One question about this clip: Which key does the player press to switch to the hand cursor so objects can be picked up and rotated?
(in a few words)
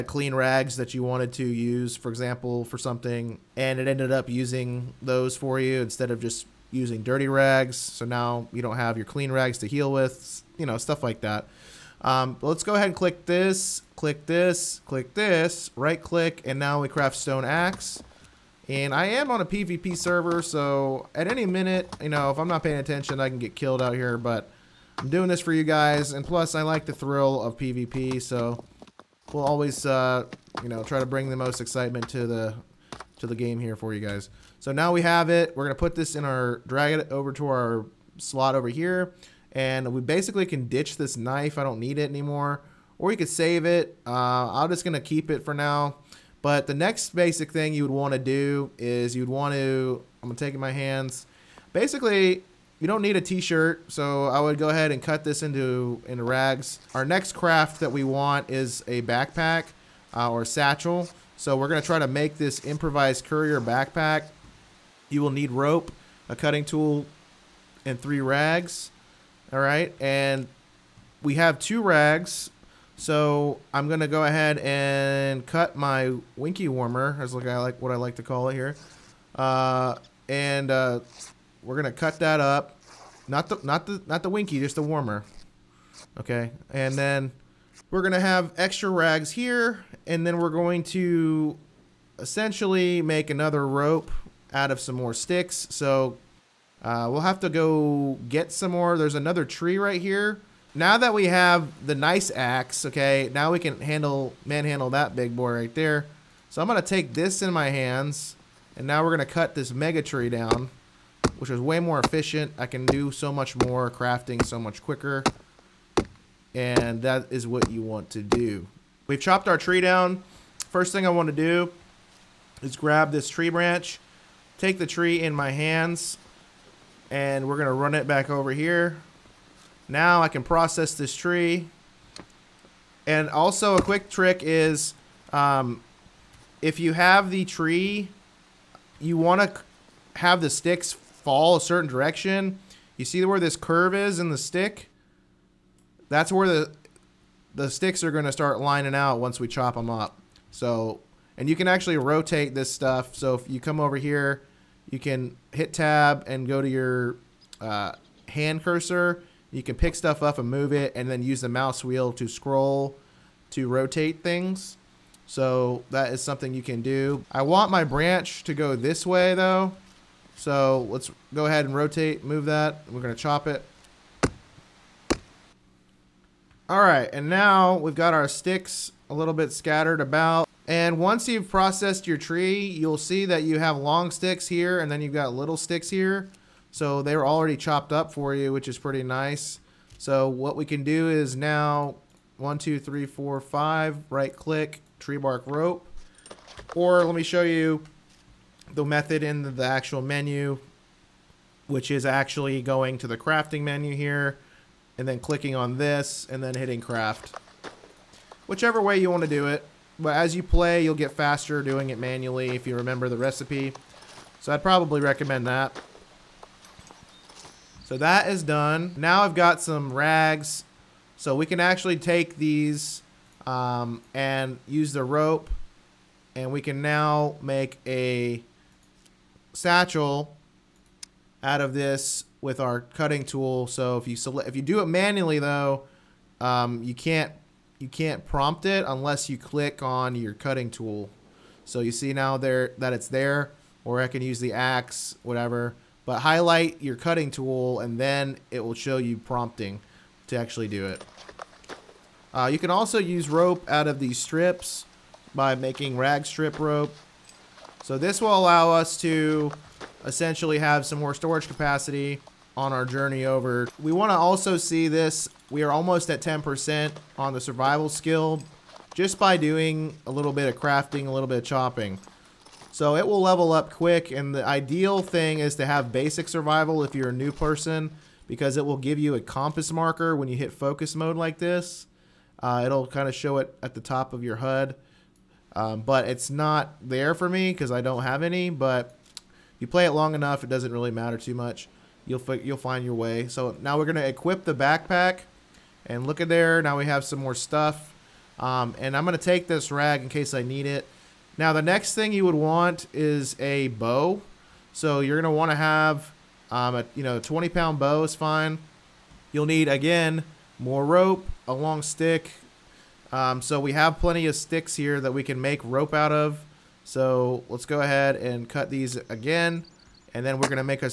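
Tab.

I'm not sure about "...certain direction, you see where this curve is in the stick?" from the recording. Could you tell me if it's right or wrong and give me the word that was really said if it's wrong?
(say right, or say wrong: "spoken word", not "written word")
right.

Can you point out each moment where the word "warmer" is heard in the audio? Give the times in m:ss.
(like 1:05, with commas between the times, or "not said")
1:16, 1:24.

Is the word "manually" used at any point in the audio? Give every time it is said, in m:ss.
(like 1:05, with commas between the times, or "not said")
3:31, 3:54.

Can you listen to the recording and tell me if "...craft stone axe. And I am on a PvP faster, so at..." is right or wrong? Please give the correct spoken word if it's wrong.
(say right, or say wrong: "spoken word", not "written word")
wrong: "server", not "faster".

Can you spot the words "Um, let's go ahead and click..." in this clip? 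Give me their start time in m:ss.
0:12.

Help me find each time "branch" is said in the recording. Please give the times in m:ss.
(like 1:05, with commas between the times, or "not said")
2:03, 2:47.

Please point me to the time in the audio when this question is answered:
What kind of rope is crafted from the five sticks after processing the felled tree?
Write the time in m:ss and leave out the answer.
3:14.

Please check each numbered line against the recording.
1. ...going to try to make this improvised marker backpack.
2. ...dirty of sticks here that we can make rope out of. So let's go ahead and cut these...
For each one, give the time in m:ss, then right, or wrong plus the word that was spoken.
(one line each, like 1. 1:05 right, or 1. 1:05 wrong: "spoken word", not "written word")
1. 1:01 wrong: "courier", not "marker"
2. 5:13 wrong: "plenty", not "dirty".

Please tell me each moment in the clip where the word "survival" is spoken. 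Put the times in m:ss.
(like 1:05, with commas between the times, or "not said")
4:27, 4:36.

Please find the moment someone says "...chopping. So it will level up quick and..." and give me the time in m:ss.
4:31.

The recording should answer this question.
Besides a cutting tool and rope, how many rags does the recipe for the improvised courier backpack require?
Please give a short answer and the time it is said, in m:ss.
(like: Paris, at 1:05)
3, at 1:07.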